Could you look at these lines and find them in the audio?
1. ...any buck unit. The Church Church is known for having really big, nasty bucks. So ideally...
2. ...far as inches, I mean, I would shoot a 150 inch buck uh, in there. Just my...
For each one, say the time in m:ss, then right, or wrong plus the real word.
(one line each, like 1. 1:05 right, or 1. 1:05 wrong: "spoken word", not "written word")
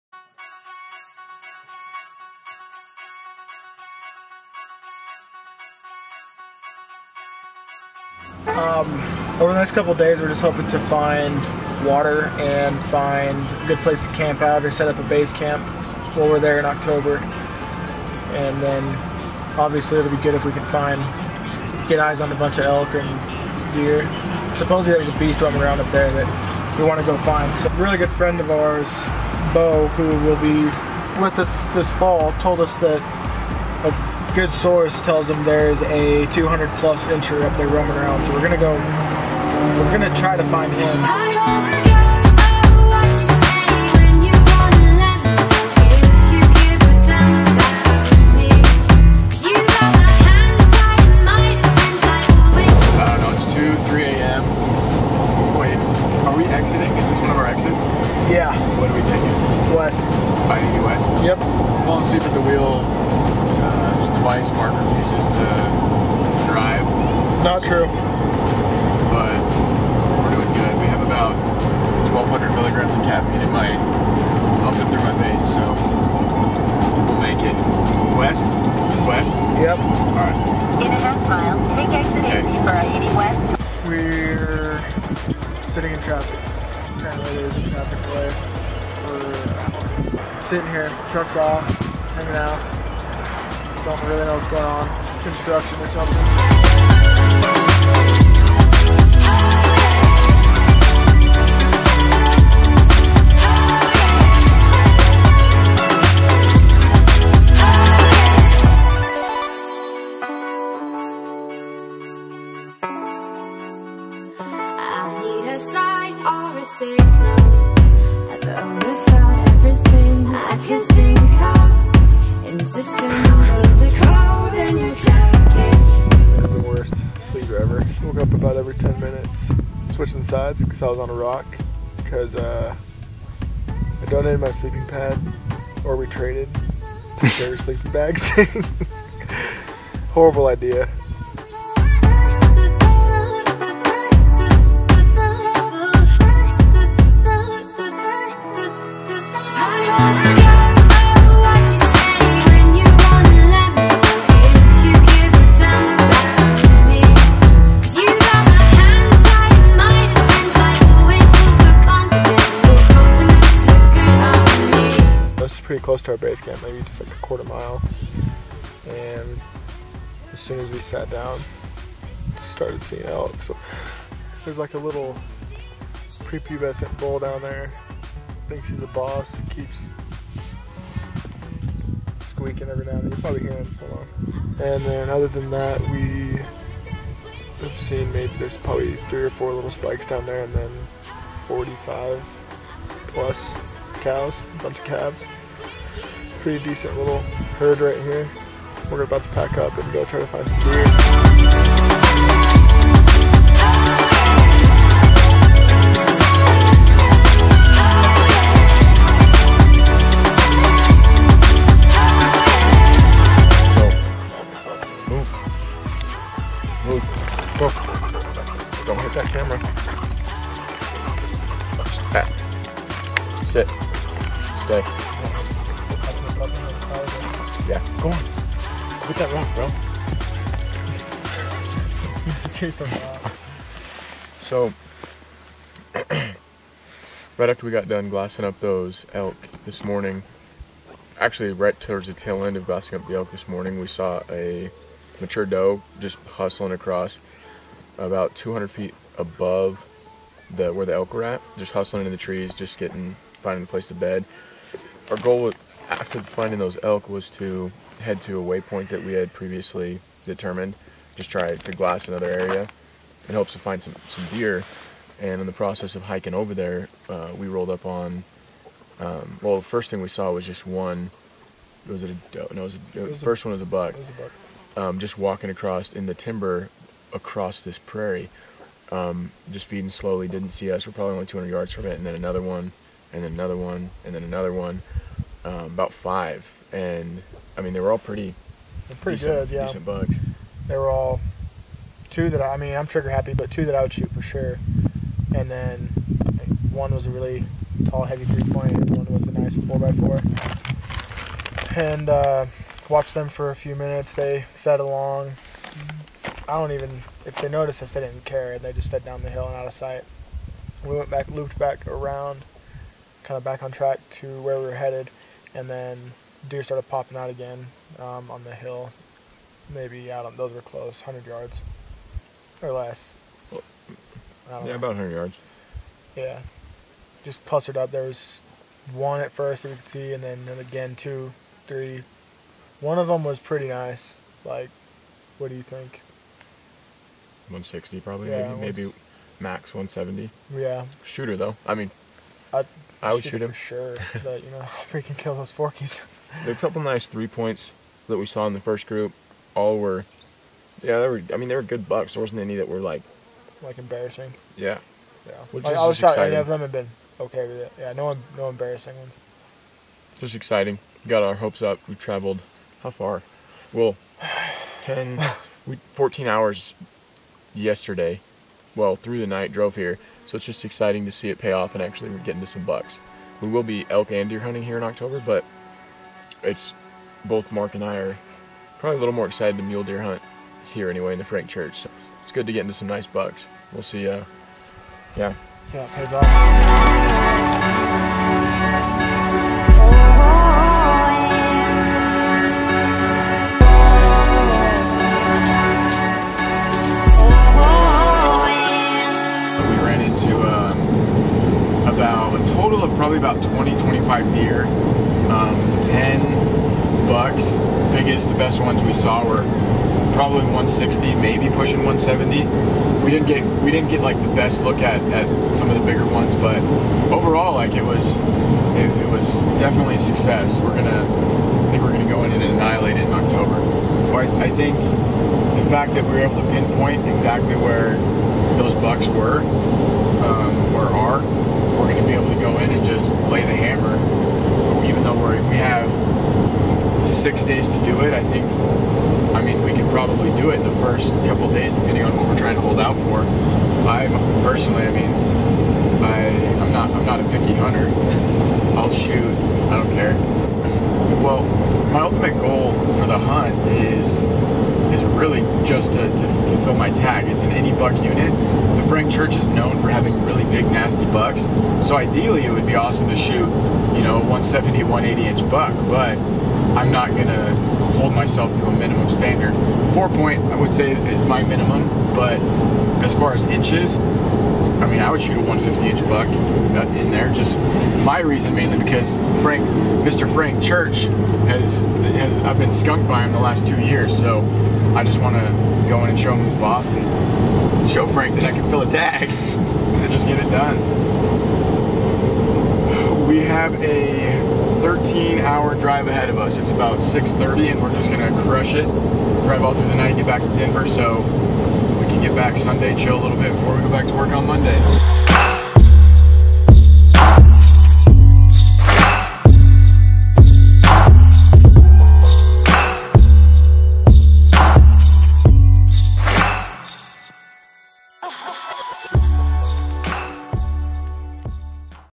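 1. 7:37 wrong: "Frank", not "Church"
2. 7:53 right.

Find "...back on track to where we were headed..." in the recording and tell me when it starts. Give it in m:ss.
5:13.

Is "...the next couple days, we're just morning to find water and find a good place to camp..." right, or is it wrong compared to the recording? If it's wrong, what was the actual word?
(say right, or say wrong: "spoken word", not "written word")
wrong: "hoping", not "morning".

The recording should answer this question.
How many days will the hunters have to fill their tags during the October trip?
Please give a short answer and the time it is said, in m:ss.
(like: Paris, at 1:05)
6, at 7:17.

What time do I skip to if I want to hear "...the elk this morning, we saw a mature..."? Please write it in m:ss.
4:03.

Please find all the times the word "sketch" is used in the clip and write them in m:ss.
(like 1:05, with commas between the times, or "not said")
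not said.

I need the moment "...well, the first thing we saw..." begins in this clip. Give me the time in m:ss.
4:29.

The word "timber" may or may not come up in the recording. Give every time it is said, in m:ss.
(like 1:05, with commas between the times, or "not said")
4:36.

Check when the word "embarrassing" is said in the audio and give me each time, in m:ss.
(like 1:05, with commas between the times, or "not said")
5:53, 5:58.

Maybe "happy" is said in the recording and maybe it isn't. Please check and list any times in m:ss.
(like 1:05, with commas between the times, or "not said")
4:53.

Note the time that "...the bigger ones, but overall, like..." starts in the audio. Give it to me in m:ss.
6:55.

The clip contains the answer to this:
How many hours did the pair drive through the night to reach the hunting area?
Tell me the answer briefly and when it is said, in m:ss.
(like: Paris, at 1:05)
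14, at 6:05.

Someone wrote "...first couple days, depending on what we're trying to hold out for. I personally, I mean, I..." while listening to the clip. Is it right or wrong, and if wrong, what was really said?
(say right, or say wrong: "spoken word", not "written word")
right.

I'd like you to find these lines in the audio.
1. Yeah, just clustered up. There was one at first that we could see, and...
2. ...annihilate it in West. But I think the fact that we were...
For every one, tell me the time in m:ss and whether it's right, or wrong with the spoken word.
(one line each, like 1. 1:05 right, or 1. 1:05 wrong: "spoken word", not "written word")
1. 5:26 right
2. 7:02 wrong: "October", not "West".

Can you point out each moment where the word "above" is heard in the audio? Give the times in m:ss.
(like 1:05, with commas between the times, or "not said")
4:09.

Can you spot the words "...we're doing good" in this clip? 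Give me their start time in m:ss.
1:10.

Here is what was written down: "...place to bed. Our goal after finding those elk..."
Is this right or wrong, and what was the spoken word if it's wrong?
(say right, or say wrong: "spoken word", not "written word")
right.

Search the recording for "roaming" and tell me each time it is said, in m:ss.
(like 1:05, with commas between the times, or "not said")
0:25, 0:37.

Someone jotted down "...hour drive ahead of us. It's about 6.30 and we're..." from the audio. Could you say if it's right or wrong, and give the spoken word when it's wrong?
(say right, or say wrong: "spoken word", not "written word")
right.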